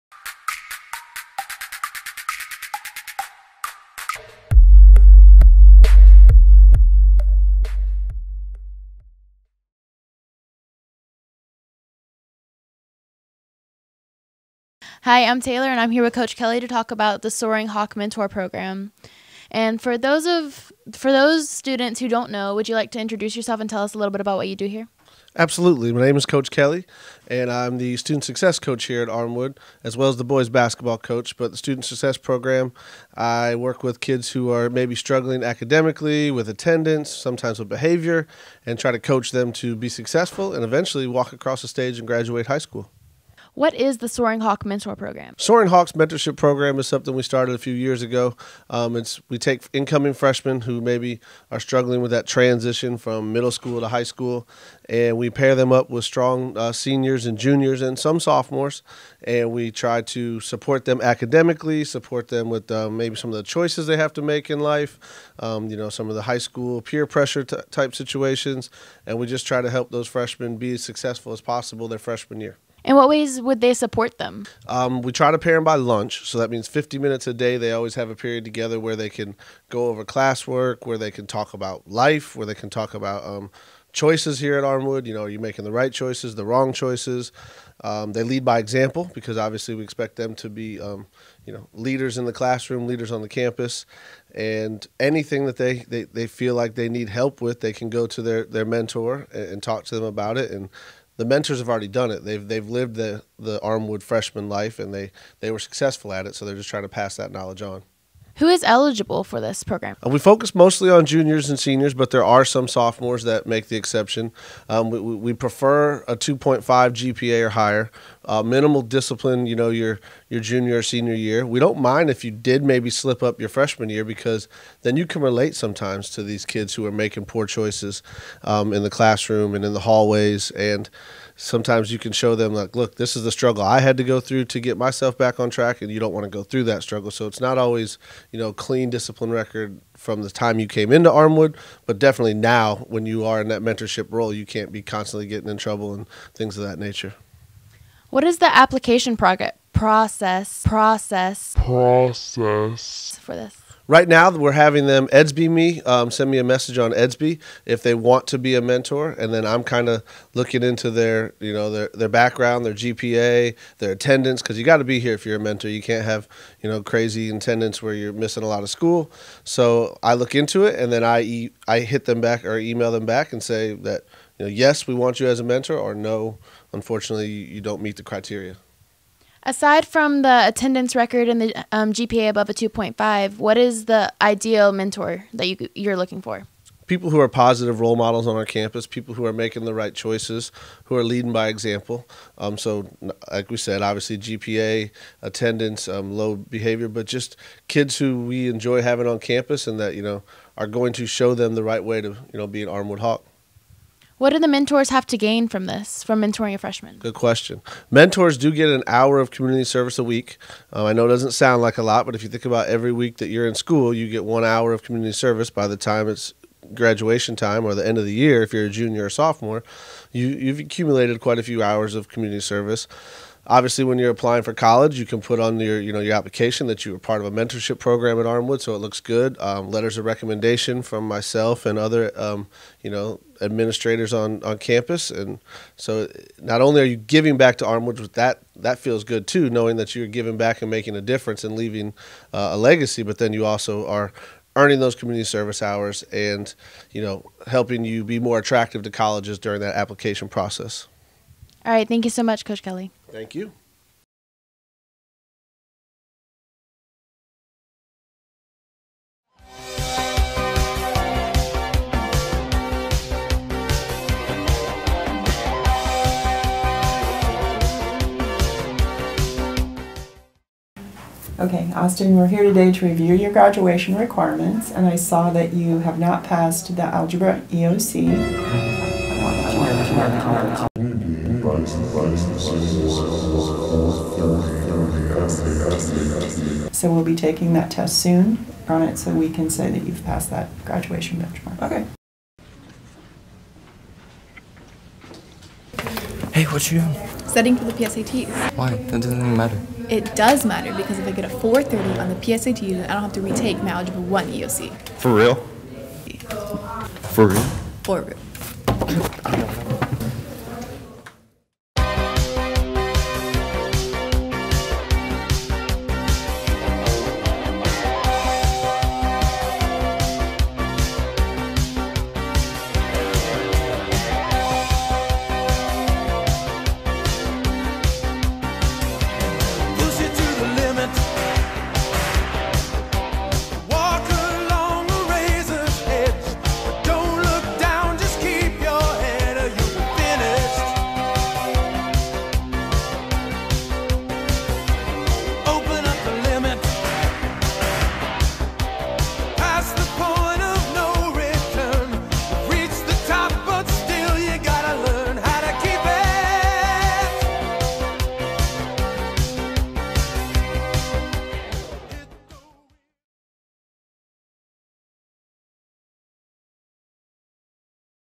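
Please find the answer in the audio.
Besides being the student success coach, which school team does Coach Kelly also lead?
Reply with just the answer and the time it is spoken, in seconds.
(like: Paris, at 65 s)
Boys basketball, at 30 s.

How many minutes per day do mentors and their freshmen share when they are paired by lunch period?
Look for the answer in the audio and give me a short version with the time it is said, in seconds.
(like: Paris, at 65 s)
50 minutes, at 76 s.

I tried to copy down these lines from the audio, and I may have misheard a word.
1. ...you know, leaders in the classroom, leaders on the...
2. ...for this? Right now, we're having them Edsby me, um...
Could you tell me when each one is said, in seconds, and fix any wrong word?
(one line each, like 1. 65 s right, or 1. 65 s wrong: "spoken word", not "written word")
1. 91 s right
2. 153 s right.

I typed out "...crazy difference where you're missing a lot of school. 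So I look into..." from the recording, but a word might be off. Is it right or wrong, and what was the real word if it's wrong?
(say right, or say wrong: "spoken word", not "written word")
wrong: "attendance", not "difference".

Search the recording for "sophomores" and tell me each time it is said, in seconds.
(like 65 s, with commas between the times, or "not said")
58 s, 112 s, 219 s.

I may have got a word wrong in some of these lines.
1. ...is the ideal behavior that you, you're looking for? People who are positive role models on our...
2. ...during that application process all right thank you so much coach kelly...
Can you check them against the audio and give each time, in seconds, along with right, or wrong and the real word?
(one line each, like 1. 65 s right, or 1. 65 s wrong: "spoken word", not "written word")
1. 183 s wrong: "mentor", not "behavior"
2. 249 s right.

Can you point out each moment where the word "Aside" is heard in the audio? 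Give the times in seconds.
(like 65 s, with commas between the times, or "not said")
179 s.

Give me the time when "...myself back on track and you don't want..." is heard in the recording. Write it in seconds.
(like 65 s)
134 s.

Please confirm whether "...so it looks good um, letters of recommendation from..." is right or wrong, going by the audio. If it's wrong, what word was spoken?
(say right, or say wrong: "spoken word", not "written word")
right.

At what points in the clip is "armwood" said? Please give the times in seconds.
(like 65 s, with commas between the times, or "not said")
29 s, 84 s, 103 s, 141 s, 202 s, 228 s, 237 s.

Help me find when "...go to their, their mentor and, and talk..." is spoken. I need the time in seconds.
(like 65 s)
97 s.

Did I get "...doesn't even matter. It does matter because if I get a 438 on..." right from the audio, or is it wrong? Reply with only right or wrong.
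wrong.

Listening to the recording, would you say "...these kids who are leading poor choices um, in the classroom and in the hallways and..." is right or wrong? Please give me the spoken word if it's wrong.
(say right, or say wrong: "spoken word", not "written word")
wrong: "making", not "leading".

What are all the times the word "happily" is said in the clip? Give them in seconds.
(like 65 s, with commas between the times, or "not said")
not said.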